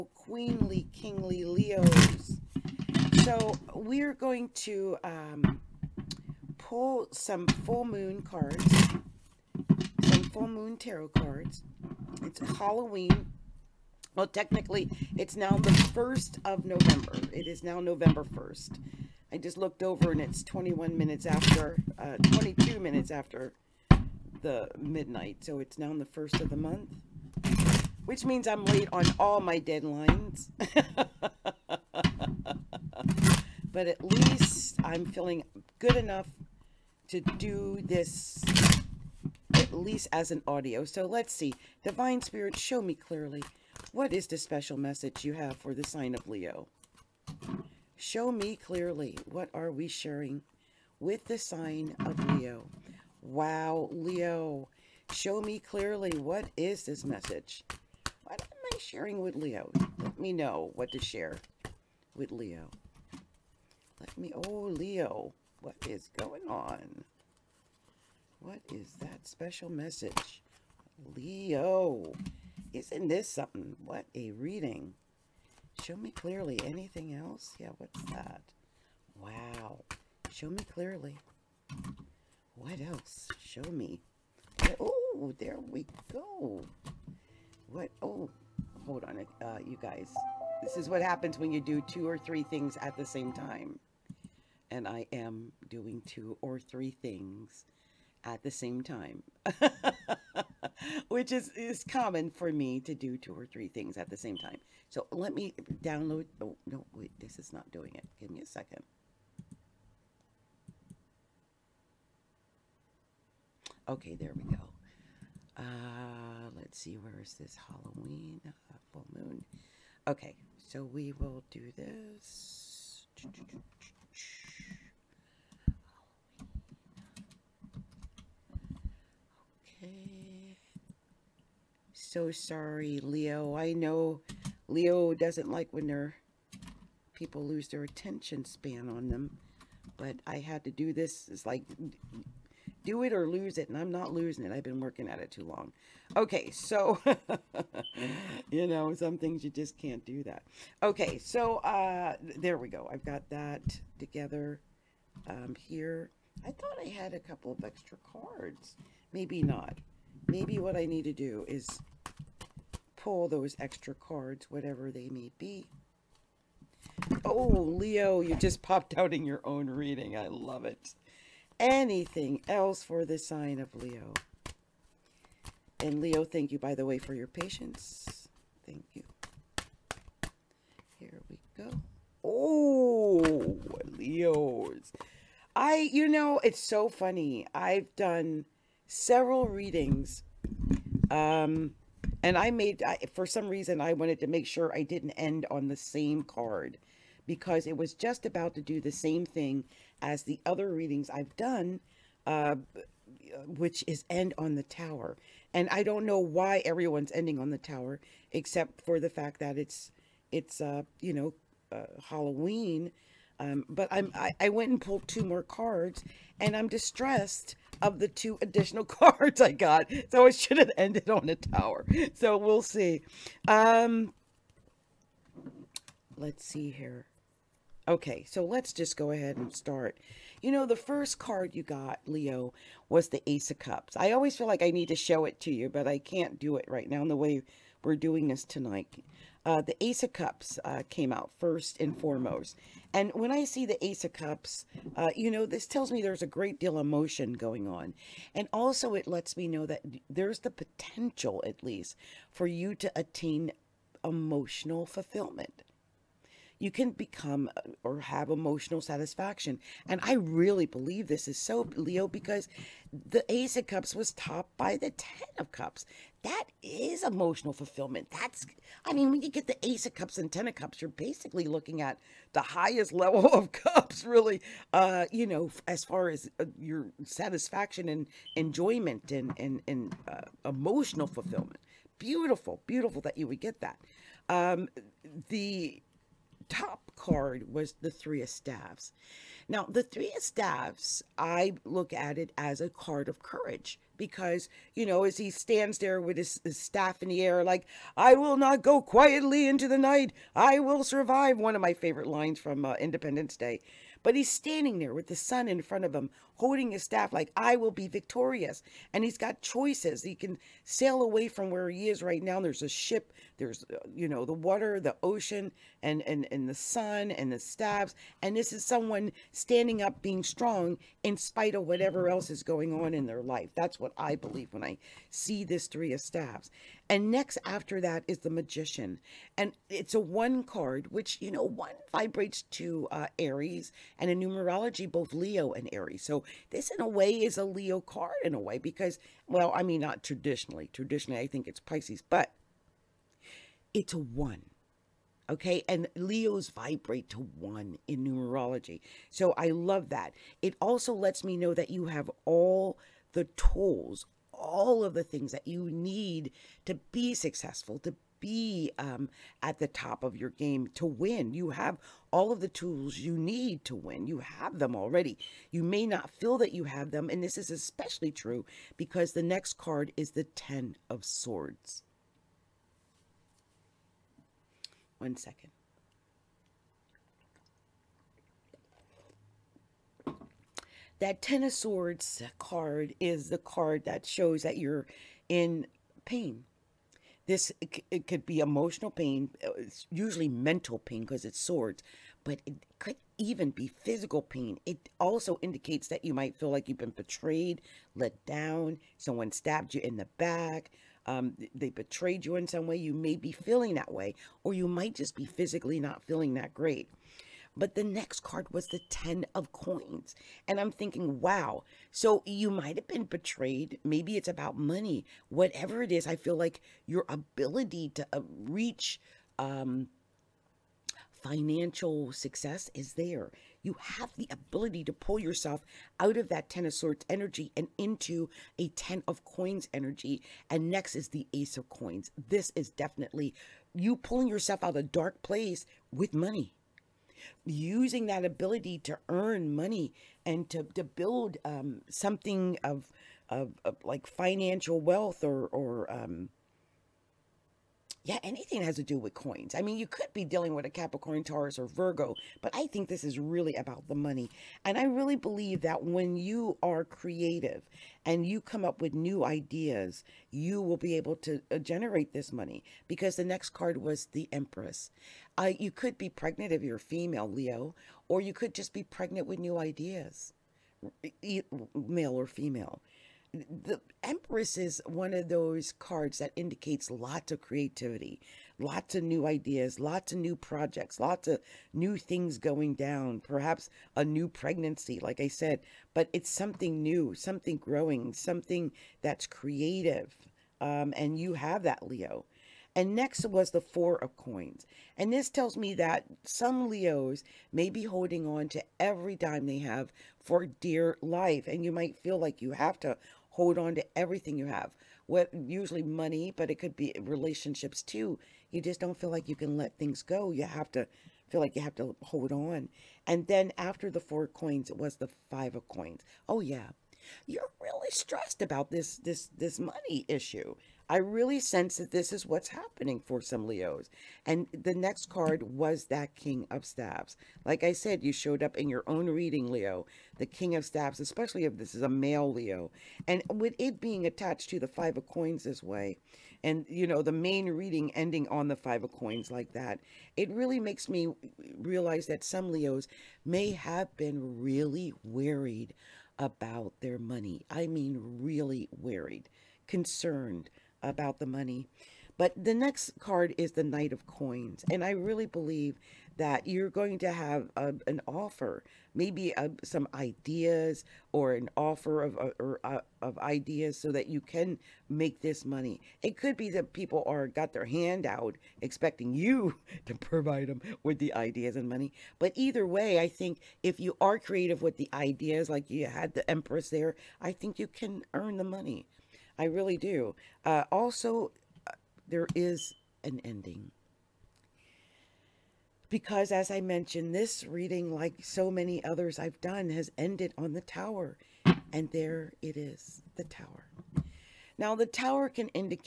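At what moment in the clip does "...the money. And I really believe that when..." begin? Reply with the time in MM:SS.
07:33.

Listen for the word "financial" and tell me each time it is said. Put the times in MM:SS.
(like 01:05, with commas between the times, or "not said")
07:01, 07:24.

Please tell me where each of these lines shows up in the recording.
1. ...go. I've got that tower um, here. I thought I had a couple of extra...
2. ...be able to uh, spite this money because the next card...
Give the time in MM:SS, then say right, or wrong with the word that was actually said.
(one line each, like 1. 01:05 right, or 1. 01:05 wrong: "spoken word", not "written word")
1. 02:32 wrong: "together", not "tower"
2. 07:40 wrong: "generate", not "spite".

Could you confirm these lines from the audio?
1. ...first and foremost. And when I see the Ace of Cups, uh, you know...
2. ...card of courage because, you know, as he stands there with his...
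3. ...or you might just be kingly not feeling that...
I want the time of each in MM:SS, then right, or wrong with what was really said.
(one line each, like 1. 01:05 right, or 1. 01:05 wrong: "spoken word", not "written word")
1. 04:01 right
2. 04:52 right
3. 06:44 wrong: "physically", not "kingly".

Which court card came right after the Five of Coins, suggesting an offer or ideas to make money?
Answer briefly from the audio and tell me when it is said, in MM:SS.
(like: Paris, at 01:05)
Knight of Coins, at 09:13.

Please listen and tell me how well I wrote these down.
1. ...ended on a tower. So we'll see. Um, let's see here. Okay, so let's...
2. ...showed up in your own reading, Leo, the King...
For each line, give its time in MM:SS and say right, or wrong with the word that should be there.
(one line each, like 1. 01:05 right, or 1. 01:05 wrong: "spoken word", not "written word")
1. 03:40 right
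2. 08:48 right.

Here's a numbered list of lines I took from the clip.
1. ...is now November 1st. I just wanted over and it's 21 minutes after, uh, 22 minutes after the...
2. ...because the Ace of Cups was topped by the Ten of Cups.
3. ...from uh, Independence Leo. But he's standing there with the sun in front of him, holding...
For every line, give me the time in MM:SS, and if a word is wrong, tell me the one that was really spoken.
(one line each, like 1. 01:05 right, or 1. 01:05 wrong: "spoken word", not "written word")
1. 00:17 wrong: "looked", not "wanted"
2. 04:22 right
3. 05:02 wrong: "Day", not "Leo".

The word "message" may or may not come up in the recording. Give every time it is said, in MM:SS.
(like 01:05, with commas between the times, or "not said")
00:44, 00:57, 01:09.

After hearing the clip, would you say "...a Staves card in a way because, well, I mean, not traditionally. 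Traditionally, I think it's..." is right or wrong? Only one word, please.
wrong.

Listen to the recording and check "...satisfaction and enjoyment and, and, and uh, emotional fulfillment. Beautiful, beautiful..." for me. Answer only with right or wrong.
right.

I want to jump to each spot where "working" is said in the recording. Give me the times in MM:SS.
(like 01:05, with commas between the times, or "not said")
02:24.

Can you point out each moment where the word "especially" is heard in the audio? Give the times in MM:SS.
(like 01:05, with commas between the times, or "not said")
06:07, 08:50.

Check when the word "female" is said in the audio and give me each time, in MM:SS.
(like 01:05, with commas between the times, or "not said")
07:46, 07:52.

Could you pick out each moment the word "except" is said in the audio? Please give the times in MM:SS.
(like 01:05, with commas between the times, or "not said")
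03:28.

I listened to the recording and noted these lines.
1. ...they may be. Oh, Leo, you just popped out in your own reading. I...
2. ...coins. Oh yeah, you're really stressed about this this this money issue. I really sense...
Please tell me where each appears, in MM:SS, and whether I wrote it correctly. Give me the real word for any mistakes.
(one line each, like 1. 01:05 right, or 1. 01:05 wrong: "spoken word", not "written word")
1. 02:44 right
2. 08:35 right.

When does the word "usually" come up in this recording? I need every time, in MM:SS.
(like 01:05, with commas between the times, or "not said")
06:29, 08:25.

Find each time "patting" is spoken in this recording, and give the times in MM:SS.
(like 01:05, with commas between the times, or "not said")
not said.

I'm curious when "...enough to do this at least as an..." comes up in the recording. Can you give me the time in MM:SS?
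00:35.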